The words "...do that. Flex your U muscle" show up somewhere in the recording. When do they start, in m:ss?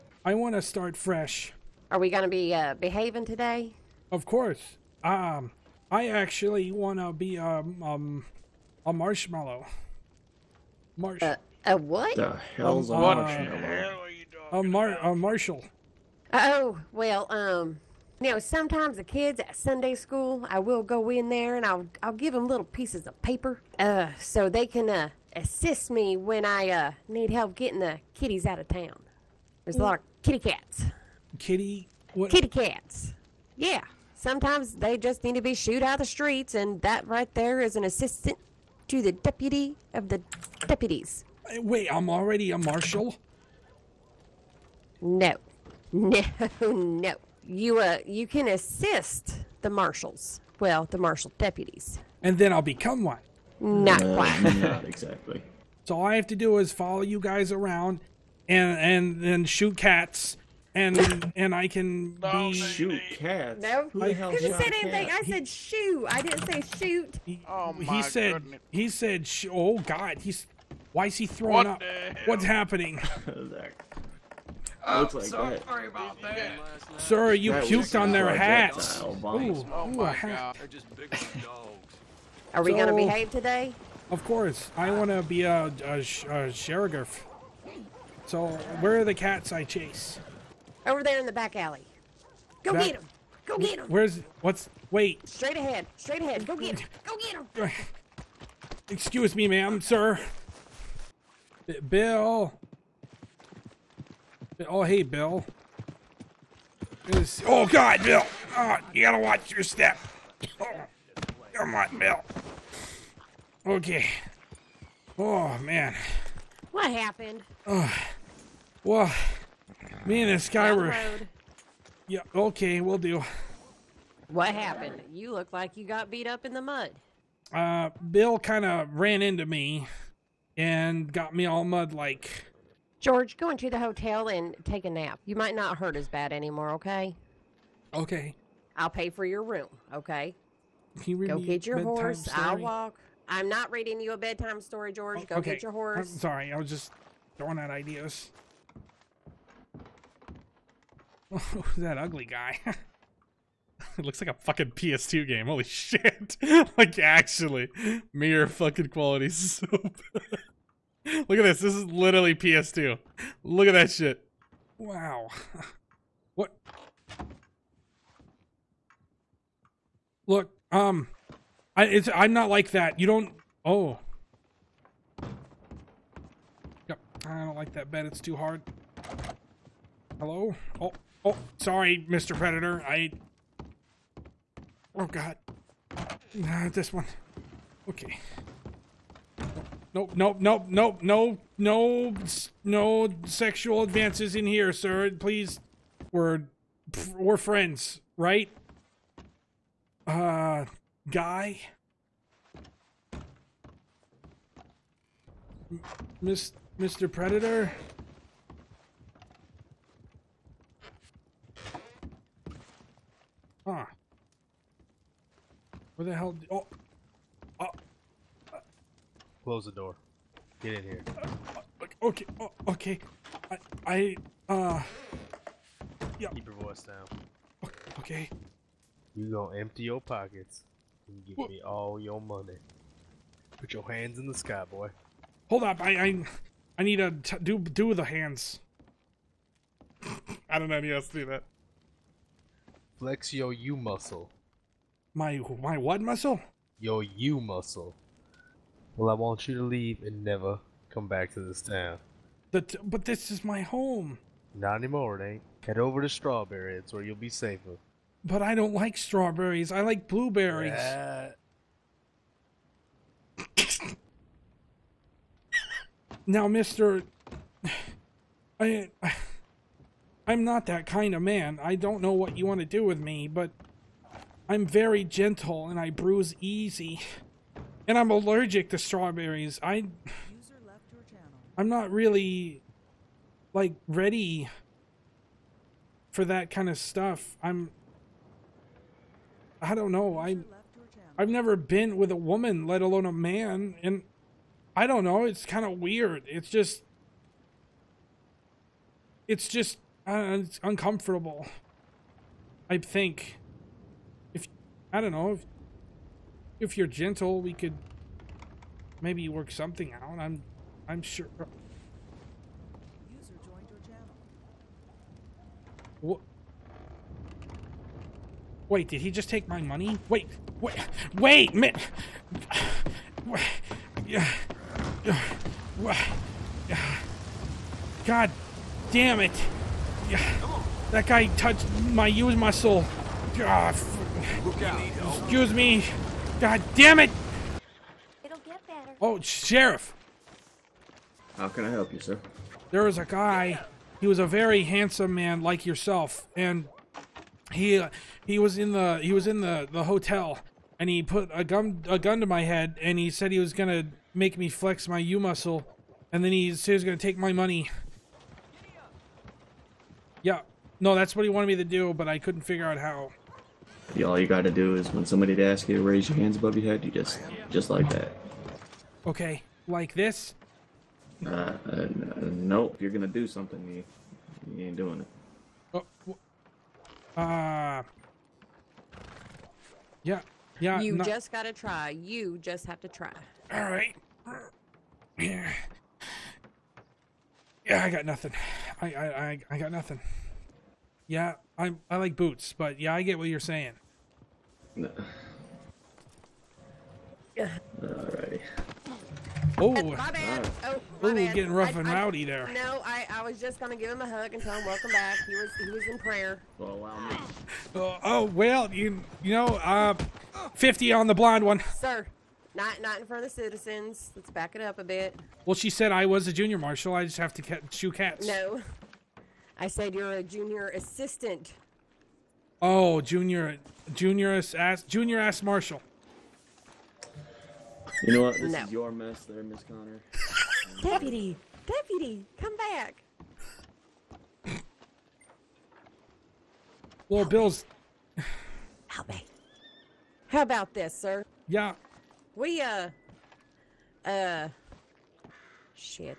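4:01.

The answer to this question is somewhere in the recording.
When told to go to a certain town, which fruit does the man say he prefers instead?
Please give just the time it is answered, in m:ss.
4:20.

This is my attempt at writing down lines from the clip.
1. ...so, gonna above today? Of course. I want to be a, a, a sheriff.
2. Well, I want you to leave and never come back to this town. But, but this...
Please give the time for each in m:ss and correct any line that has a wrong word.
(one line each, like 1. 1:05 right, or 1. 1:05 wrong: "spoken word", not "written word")
1. 1:22 wrong: "behave", not "above"
2. 4:08 right.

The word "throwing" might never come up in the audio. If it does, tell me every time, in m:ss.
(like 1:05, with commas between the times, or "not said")
1:11, 2:27.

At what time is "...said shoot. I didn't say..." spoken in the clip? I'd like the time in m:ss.
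1:05.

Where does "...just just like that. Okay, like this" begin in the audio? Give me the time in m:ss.
6:06.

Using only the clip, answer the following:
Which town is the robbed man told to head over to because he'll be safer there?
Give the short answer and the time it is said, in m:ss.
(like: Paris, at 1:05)
Strawberry, at 4:16.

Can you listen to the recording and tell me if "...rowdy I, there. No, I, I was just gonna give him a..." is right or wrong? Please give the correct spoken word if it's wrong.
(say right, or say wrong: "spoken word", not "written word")
right.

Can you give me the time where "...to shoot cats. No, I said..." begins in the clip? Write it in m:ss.
6:57.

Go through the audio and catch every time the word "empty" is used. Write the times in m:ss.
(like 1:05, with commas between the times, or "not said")
3:49.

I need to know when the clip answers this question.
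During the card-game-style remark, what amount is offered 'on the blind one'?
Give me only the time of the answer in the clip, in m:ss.
6:50.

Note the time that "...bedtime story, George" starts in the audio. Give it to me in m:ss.
2:24.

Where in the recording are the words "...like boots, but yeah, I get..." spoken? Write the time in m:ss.
6:31.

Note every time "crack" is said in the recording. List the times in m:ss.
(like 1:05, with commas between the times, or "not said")
not said.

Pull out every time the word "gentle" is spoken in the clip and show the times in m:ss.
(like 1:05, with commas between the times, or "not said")
4:35, 5:06.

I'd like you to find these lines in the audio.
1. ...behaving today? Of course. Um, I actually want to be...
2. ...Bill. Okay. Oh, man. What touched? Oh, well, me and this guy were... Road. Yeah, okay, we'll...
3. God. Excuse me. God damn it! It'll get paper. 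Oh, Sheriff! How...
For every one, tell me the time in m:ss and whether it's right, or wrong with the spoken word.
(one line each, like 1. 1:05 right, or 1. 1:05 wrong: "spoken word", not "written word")
1. 0:02 right
2. 1:51 wrong: "happened", not "touched"
3. 5:33 wrong: "better", not "paper".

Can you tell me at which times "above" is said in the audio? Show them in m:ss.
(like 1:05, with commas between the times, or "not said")
6:06.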